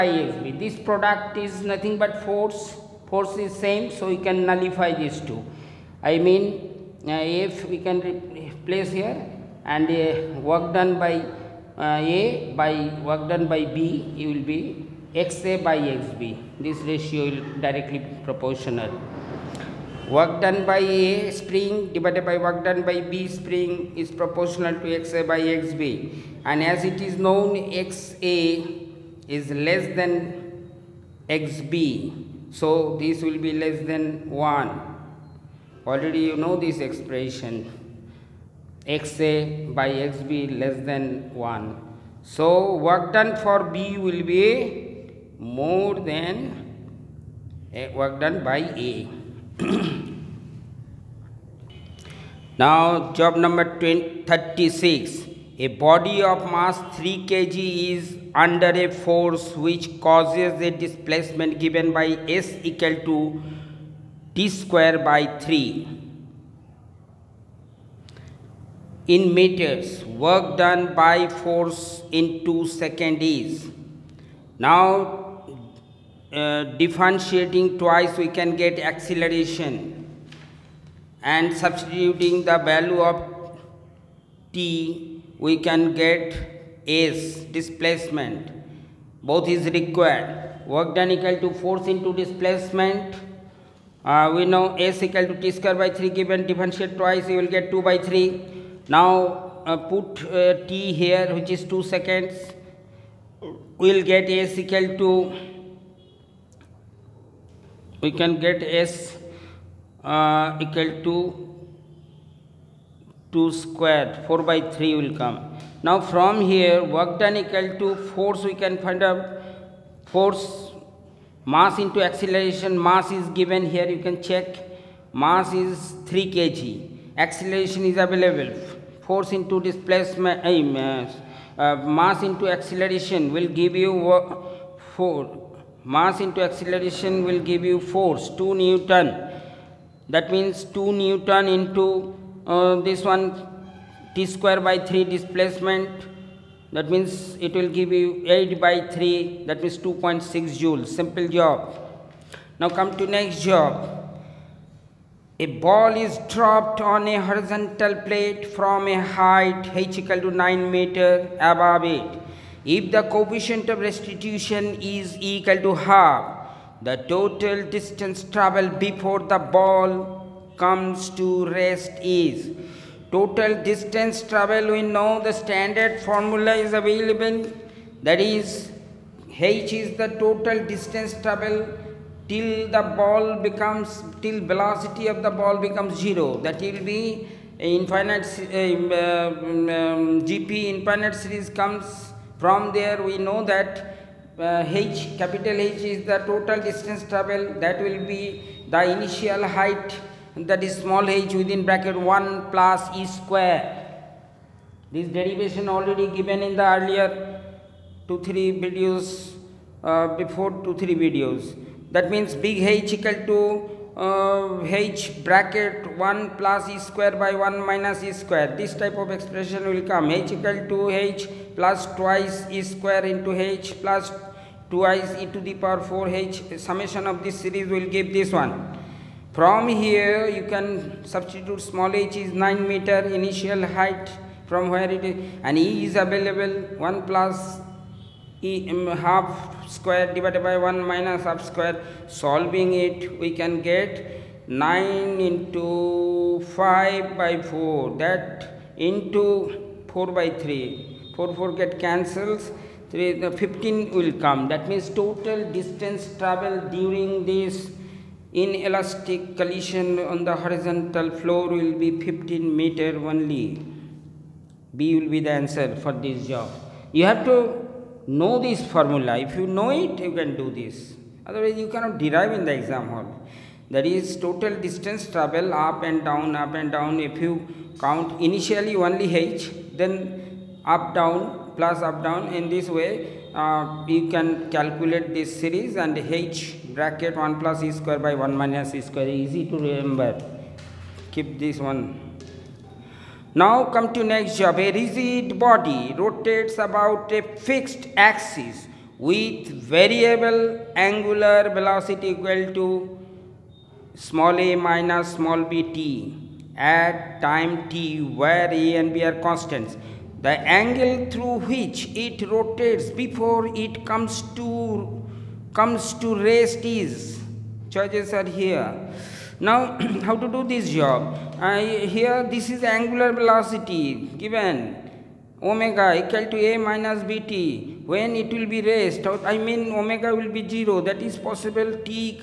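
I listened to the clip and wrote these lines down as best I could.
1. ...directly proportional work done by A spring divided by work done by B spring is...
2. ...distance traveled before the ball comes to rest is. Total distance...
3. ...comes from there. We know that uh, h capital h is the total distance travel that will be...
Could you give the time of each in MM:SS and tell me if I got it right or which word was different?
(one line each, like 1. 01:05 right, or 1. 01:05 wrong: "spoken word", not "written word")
1. 00:17 right
2. 02:47 right
3. 03:11 right.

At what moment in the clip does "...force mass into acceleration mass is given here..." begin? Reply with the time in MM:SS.
02:00.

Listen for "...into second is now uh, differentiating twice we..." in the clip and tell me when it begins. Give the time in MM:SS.
01:12.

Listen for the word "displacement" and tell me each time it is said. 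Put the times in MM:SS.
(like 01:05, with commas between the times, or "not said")
01:00, 01:27, 01:32, 02:09, 02:25.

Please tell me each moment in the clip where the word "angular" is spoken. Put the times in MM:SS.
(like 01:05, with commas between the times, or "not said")
05:00, 05:22.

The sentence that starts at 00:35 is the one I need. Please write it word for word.
Already you know this expression xa by xb less than 1.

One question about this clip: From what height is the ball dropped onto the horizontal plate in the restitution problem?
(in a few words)
9 meter.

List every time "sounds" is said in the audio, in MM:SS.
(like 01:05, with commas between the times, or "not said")
not said.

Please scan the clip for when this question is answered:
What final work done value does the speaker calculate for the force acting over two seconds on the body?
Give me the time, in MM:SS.
02:29.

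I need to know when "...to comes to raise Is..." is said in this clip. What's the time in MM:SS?
05:14.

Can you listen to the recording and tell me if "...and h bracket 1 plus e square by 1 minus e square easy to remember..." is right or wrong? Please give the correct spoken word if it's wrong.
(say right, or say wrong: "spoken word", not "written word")
right.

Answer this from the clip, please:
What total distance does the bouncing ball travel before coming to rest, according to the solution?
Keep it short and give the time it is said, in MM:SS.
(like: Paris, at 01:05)
15 meter, at 04:22.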